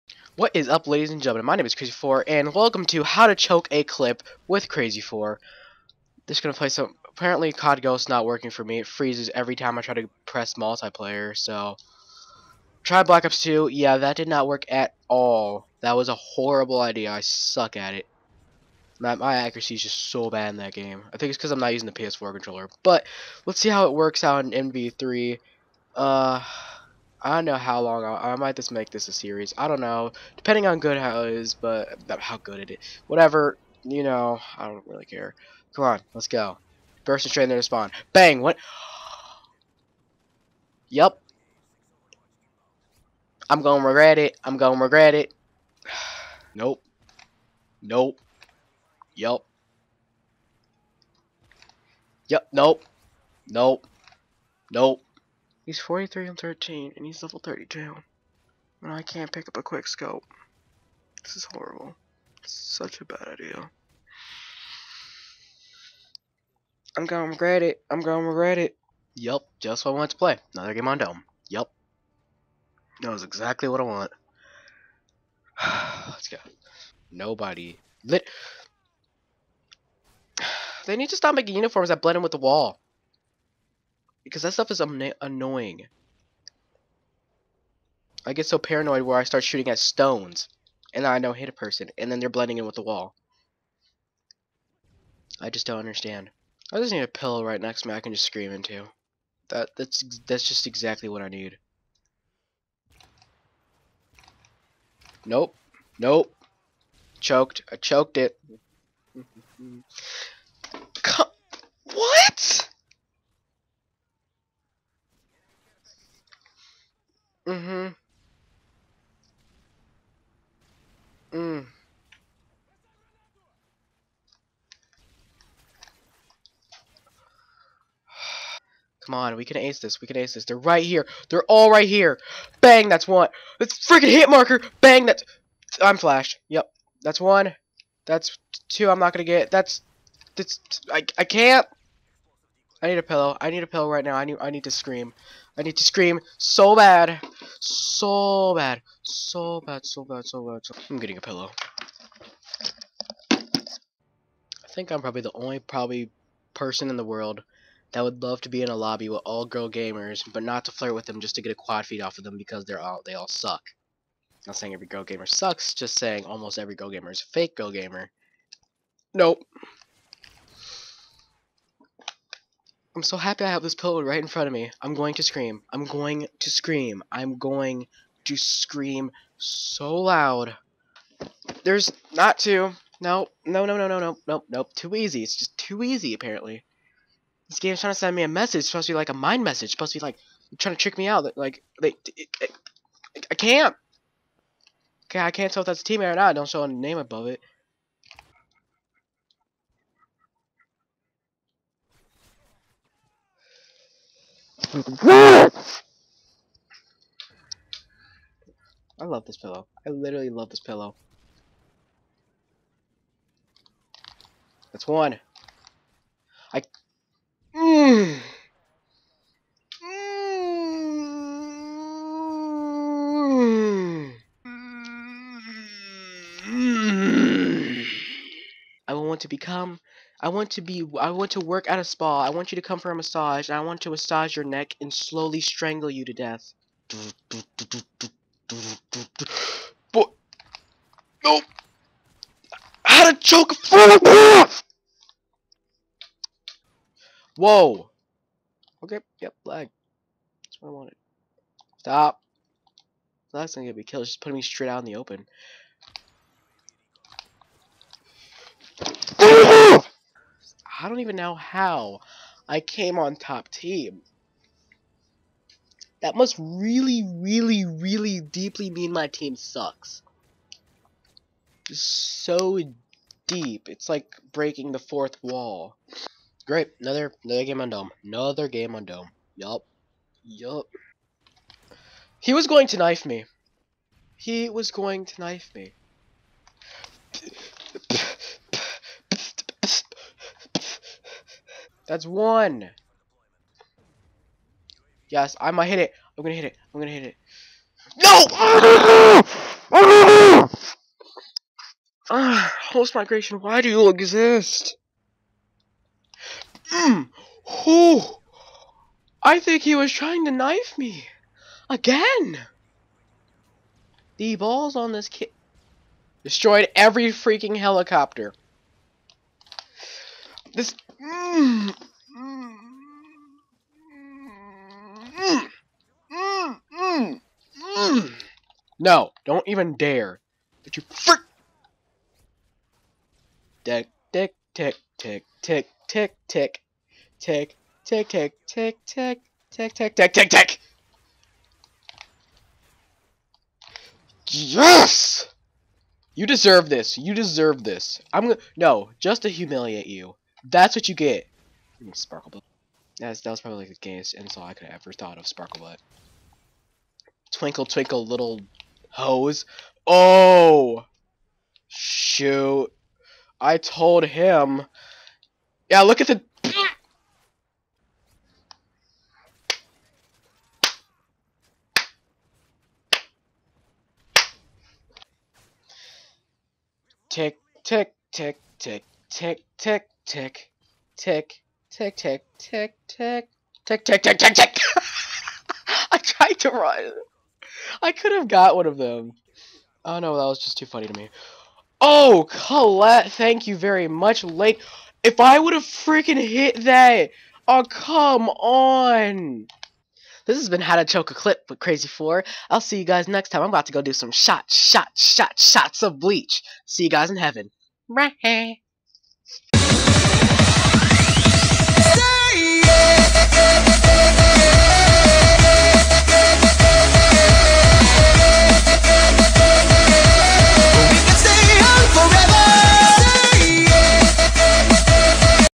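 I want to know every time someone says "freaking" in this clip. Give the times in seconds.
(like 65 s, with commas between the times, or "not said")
133 s, 317 s, 395 s.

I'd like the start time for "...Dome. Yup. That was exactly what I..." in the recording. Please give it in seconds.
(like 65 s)
70 s.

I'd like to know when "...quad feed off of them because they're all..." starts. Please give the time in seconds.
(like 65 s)
161 s.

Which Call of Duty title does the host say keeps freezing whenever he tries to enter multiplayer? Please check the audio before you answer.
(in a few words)
COD Ghosts.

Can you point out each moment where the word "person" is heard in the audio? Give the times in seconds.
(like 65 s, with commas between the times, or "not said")
91 s, 156 s.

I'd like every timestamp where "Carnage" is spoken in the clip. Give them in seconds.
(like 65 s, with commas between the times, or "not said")
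not said.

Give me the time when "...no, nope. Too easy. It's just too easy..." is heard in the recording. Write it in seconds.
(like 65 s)
184 s.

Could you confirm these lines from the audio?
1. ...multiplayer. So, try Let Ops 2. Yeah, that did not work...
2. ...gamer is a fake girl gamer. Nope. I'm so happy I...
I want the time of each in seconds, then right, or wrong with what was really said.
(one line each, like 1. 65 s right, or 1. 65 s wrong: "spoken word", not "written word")
1. 10 s wrong: "Black", not "Let"
2. 166 s right.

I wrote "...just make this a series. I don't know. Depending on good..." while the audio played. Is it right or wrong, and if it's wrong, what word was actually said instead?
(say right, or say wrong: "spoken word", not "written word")
right.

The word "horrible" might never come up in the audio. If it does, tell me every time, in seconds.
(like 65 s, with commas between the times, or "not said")
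16 s, 61 s.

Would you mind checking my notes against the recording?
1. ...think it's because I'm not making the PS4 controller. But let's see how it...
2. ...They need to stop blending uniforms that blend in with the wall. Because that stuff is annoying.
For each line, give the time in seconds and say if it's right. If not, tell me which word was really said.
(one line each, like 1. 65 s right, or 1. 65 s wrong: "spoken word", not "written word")
1. 21 s wrong: "using", not "making"
2. 80 s wrong: "making", not "blending".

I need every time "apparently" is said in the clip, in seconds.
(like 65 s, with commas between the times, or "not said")
7 s, 186 s.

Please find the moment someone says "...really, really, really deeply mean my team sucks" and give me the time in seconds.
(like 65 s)
266 s.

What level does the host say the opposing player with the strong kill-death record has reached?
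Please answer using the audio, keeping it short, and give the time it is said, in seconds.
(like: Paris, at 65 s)
32, at 57 s.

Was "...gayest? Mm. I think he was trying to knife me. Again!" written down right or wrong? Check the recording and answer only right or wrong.
wrong.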